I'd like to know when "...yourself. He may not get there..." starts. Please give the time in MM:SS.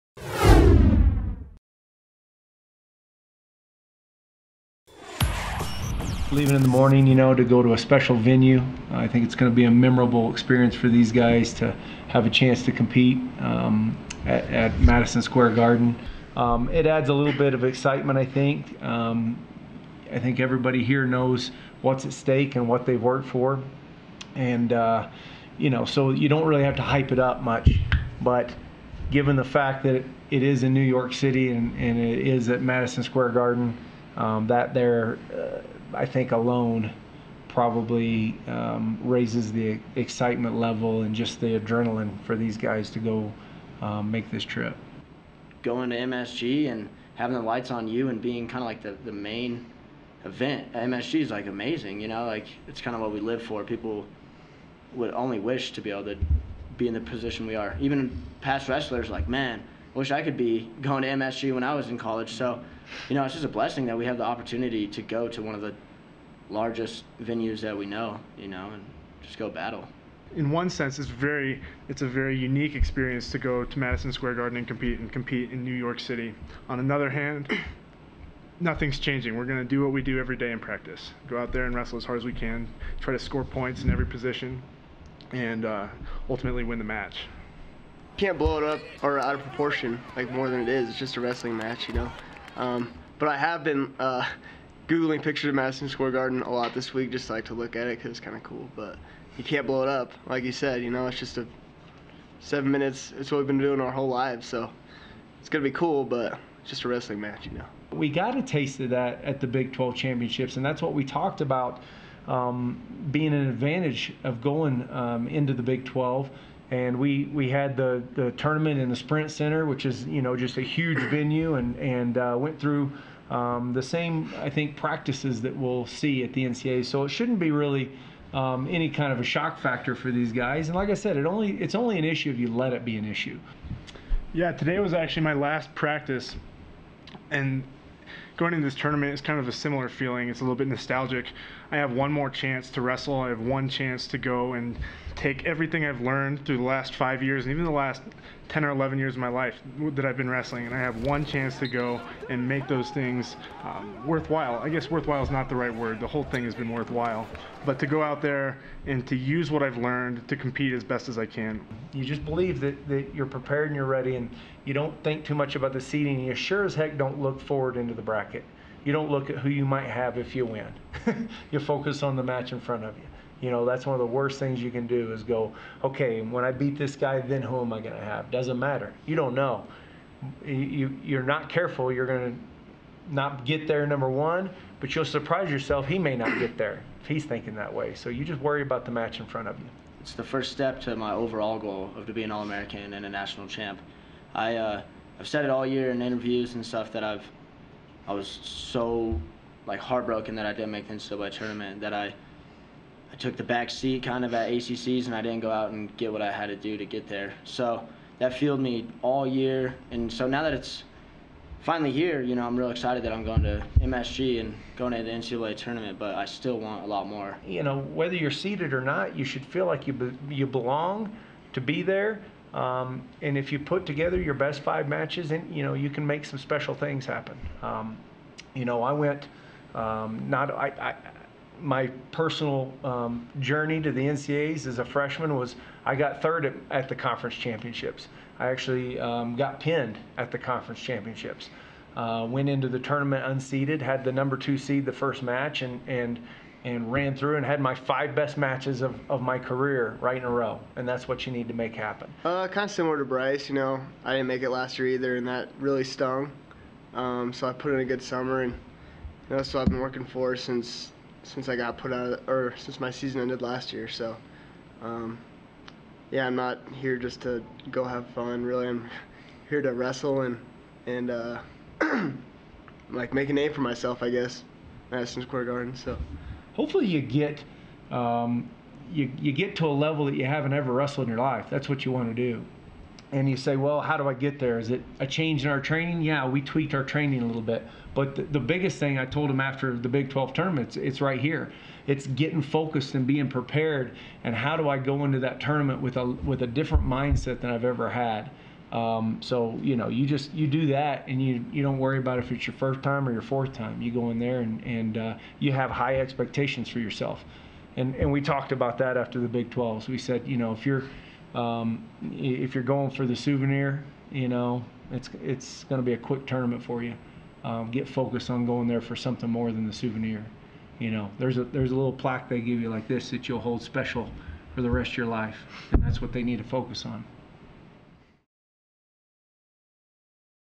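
03:05.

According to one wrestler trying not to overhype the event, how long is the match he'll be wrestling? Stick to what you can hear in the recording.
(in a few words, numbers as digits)
7 minutes.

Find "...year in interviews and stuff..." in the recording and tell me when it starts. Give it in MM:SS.
03:15.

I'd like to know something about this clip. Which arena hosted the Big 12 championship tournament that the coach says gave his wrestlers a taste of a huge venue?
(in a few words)
Sprint Center.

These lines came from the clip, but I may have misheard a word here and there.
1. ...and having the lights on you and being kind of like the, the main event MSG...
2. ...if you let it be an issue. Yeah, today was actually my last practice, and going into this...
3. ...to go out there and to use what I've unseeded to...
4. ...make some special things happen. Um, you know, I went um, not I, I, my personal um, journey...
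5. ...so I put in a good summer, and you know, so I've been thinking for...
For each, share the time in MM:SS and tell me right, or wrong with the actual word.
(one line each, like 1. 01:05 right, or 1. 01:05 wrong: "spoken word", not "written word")
1. 00:46 right
2. 02:12 right
3. 02:37 wrong: "learned", not "unseeded"
4. 03:46 right
5. 04:17 wrong: "working", not "thinking".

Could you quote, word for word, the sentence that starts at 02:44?
And you don't think too much about the seeding.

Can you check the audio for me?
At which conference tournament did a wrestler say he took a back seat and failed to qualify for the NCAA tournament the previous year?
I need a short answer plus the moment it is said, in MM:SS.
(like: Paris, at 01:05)
ACCs, at 03:24.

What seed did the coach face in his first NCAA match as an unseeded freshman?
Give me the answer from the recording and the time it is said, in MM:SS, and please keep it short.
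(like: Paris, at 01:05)
Number 2 seed, at 04:04.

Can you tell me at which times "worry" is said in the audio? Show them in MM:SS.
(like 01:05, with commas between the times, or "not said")
03:08, 05:01.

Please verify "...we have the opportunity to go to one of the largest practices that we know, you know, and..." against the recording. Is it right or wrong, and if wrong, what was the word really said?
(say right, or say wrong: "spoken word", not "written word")
wrong: "venues", not "practices".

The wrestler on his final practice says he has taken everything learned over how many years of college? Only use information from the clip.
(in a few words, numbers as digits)
5 years.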